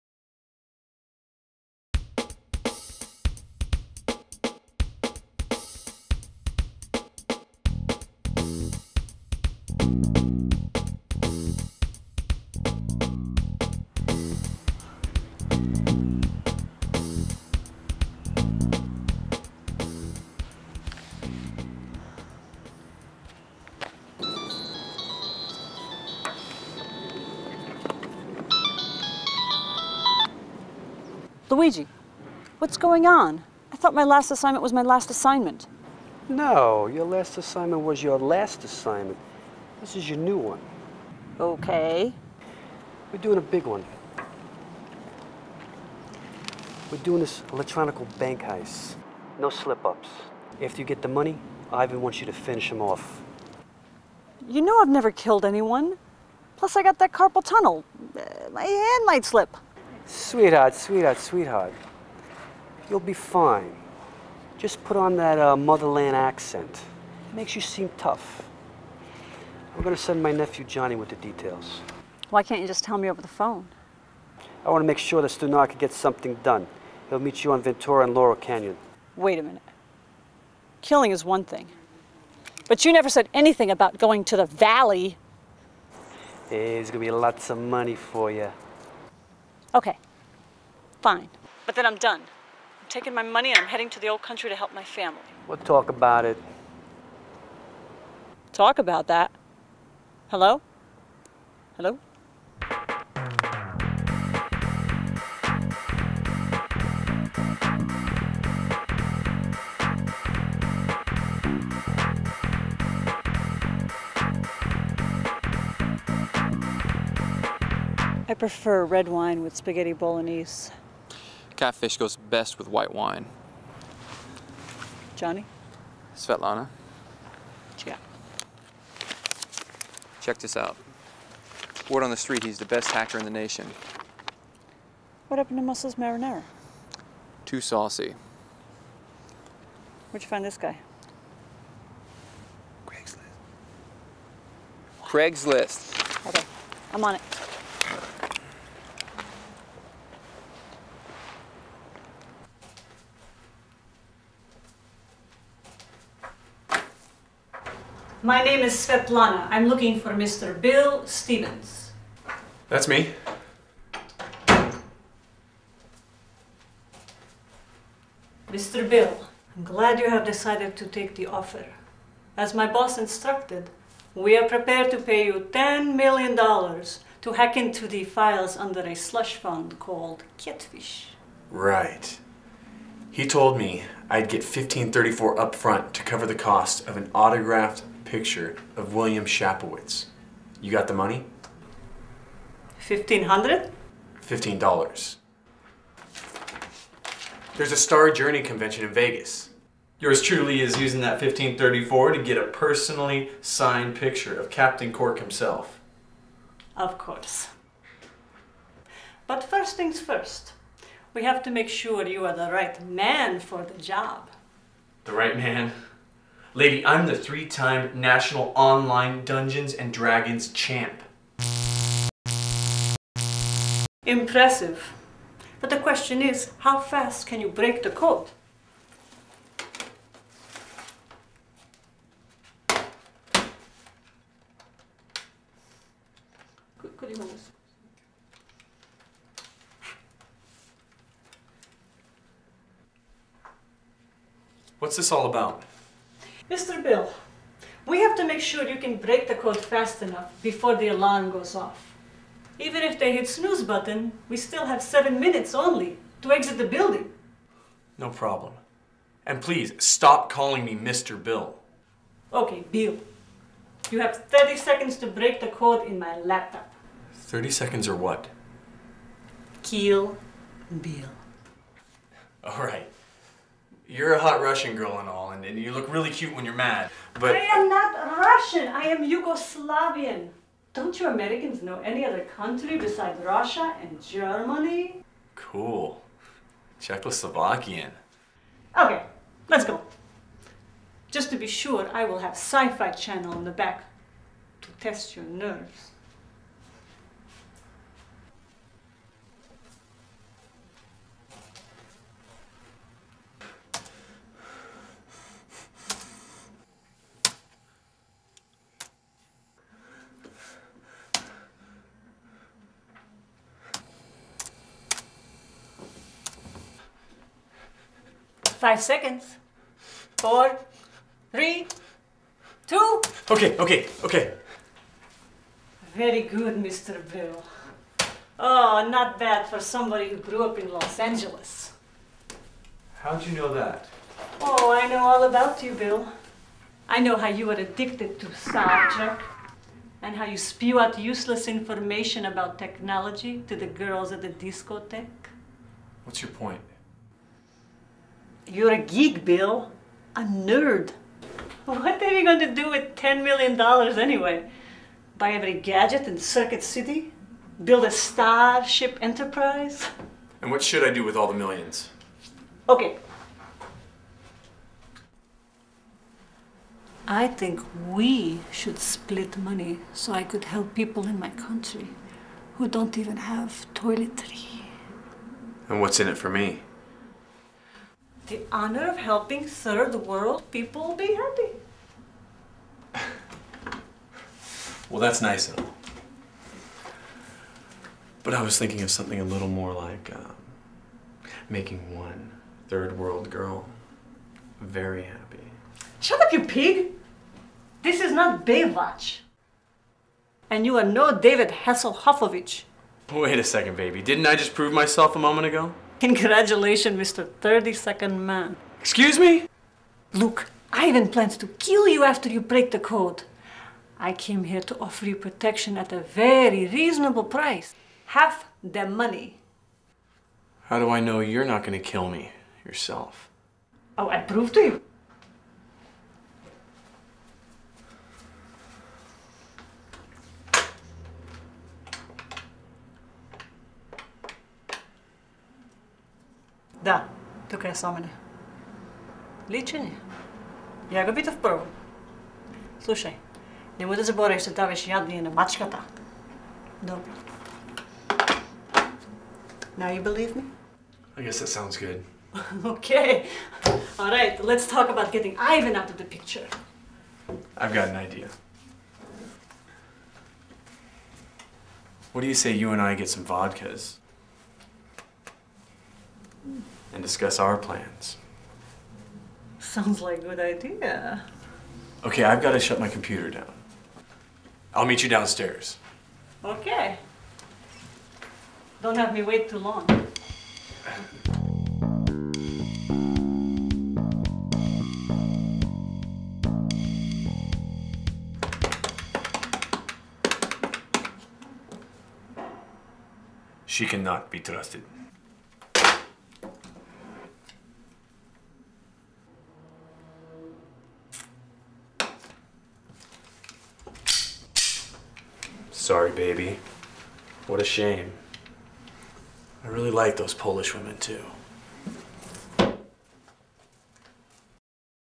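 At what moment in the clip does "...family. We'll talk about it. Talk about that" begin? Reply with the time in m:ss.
1:34.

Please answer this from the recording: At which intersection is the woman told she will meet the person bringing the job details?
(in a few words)
Ventura and Laurel Canyon.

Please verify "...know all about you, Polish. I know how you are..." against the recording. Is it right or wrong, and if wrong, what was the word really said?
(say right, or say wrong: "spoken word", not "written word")
wrong: "Bill", not "Polish".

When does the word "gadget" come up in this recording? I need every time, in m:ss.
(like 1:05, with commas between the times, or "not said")
5:55.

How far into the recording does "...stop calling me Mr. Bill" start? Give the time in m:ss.
4:19.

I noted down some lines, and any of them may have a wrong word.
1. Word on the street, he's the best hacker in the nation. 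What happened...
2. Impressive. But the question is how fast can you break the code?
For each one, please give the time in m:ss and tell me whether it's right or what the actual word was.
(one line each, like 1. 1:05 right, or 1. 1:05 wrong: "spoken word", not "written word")
1. 2:11 right
2. 3:44 right.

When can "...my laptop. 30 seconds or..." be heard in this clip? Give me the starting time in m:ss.
4:25.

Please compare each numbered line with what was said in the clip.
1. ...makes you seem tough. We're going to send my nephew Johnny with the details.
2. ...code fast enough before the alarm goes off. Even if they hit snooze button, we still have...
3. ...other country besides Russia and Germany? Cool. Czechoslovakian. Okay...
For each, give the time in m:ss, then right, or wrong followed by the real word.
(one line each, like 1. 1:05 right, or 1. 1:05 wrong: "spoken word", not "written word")
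1. 1:07 right
2. 4:09 right
3. 4:42 right.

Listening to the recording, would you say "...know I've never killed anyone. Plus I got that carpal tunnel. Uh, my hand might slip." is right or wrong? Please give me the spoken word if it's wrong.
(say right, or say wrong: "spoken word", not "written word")
right.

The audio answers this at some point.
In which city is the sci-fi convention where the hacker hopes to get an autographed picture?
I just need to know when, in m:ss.
3:18.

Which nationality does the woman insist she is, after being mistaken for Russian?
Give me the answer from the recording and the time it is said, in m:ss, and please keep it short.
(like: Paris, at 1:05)
Yugoslavian, at 4:39.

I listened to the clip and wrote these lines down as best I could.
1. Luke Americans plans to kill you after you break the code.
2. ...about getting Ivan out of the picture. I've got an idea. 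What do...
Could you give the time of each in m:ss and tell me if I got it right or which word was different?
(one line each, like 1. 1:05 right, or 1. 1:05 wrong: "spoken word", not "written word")
1. 6:50 wrong: "Ivan", not "Americans"
2. 7:34 right.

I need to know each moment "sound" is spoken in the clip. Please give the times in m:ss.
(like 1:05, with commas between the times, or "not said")
5:38, 7:31, 7:49.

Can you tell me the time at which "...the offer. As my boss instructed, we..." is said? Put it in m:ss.
2:51.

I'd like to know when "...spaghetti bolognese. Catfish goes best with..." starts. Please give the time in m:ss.
1:59.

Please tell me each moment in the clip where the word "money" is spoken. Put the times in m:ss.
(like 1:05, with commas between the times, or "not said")
0:51, 1:27, 1:33, 3:10, 6:09, 6:58.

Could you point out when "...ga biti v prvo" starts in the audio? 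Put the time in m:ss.
7:21.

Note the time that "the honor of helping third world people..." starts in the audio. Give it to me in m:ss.
6:18.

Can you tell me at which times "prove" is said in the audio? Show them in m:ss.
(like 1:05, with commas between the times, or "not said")
6:44, 7:04.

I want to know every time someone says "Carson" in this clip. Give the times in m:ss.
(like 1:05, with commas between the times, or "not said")
not said.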